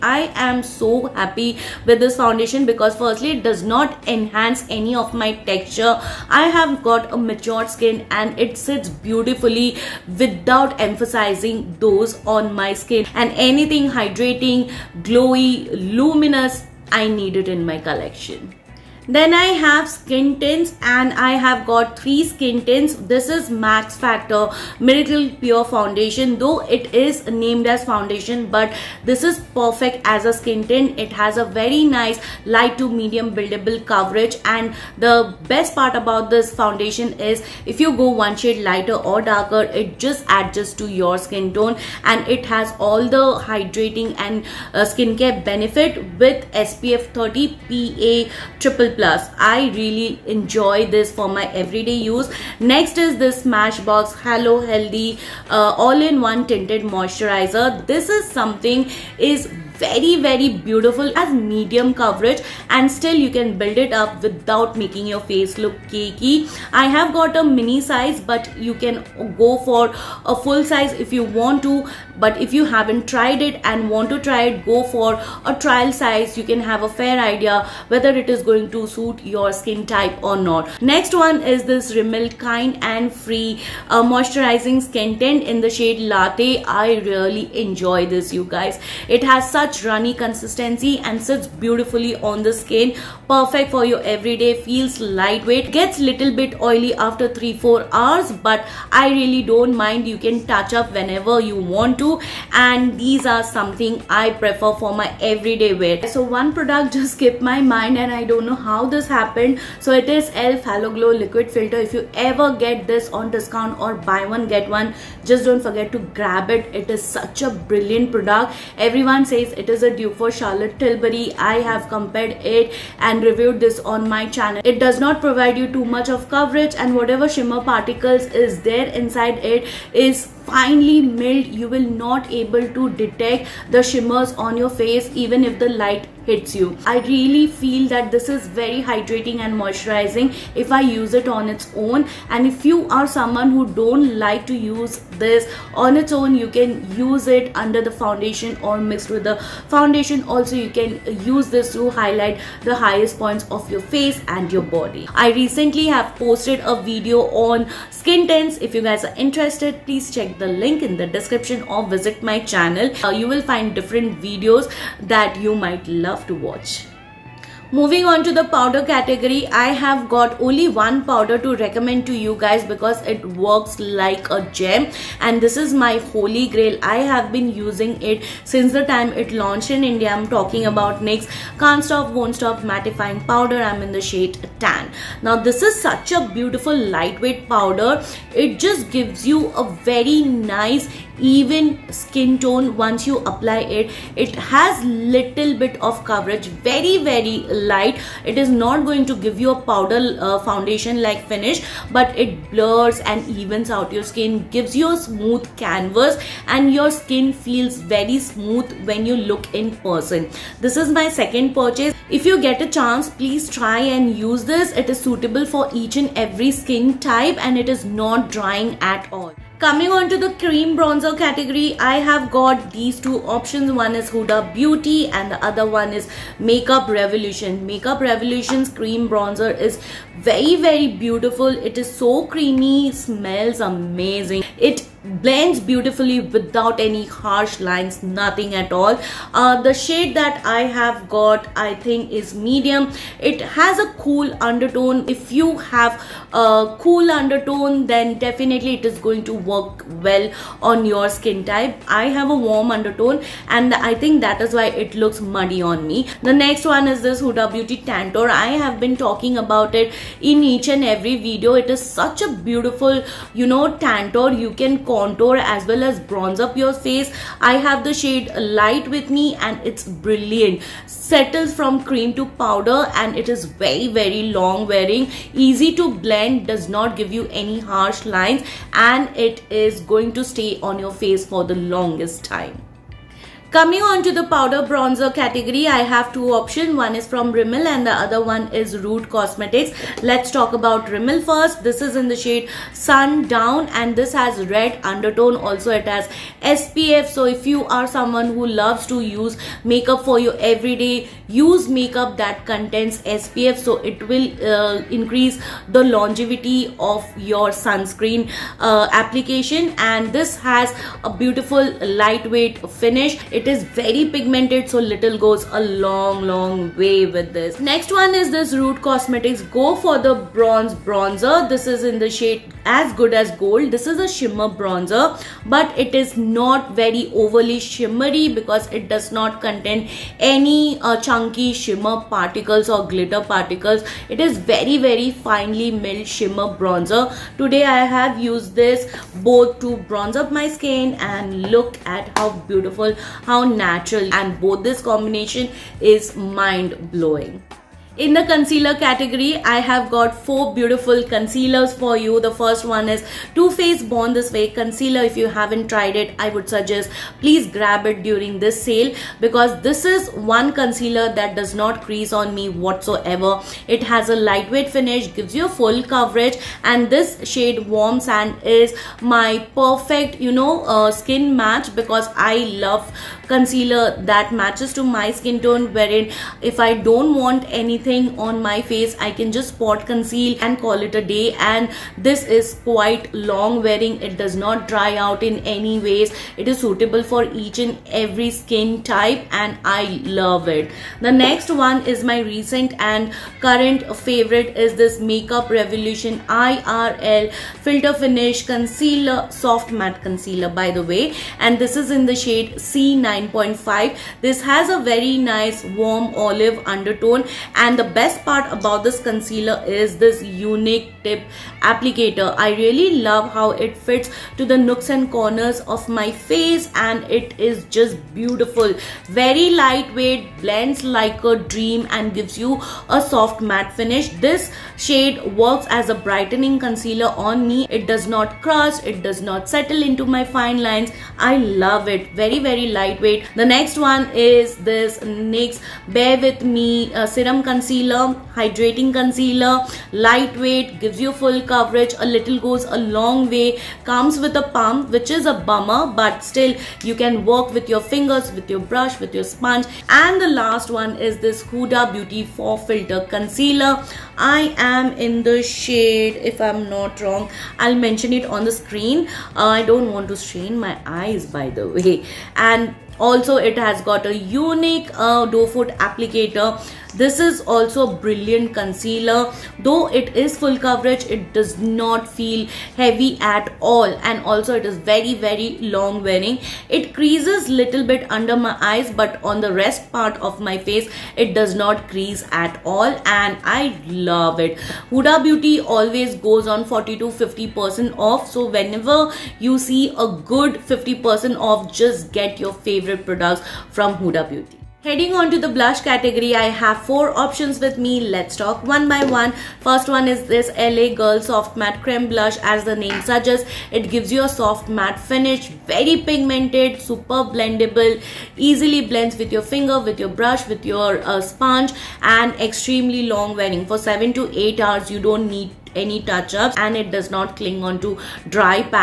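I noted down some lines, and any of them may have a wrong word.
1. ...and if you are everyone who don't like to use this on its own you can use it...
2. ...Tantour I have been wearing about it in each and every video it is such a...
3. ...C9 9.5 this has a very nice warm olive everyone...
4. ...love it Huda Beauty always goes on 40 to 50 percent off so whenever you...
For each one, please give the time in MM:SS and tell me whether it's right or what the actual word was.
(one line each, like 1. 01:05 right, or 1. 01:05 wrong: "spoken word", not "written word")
1. 02:22 wrong: "someone", not "everyone"
2. 04:17 wrong: "talking", not "wearing"
3. 06:42 wrong: "undertone", not "everyone"
4. 08:03 right.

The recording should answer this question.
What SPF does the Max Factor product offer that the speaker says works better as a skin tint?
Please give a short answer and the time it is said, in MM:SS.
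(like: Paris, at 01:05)
SPF 30, at 00:46.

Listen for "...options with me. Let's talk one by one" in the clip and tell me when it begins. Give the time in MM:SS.
08:17.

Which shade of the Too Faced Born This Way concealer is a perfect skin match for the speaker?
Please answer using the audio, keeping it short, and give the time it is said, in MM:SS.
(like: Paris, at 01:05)
Warm Sand, at 06:07.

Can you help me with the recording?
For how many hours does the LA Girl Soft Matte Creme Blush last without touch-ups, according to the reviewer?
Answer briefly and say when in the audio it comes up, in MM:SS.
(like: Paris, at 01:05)
7 to 8, at 08:33.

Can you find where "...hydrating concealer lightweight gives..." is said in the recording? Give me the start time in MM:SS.
07:18.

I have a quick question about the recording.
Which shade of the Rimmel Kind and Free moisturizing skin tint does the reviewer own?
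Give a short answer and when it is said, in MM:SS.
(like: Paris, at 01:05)
Latte, at 01:26.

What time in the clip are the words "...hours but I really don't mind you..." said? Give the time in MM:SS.
01:37.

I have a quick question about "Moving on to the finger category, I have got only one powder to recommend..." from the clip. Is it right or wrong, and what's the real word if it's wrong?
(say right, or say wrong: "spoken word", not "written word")
wrong: "powder", not "finger".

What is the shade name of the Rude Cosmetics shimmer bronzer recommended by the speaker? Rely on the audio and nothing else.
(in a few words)
As Good As Gold.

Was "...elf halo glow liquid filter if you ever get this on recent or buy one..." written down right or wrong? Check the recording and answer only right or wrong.
wrong.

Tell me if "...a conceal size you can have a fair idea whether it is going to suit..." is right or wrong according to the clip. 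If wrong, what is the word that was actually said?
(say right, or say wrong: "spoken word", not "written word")
wrong: "trial", not "conceal".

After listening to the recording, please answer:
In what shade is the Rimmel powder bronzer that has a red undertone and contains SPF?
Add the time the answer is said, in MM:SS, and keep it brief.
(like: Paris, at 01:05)
Sun Down, at 04:52.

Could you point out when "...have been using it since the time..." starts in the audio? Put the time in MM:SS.
02:57.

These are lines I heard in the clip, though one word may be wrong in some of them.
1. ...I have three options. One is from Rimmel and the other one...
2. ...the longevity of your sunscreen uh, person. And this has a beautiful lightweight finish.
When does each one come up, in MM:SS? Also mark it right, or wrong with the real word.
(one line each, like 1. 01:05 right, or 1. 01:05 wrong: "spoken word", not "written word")
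1. 04:45 wrong: "two", not "three"
2. 05:05 wrong: "application", not "person".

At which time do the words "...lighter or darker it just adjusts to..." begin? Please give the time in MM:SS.
00:38.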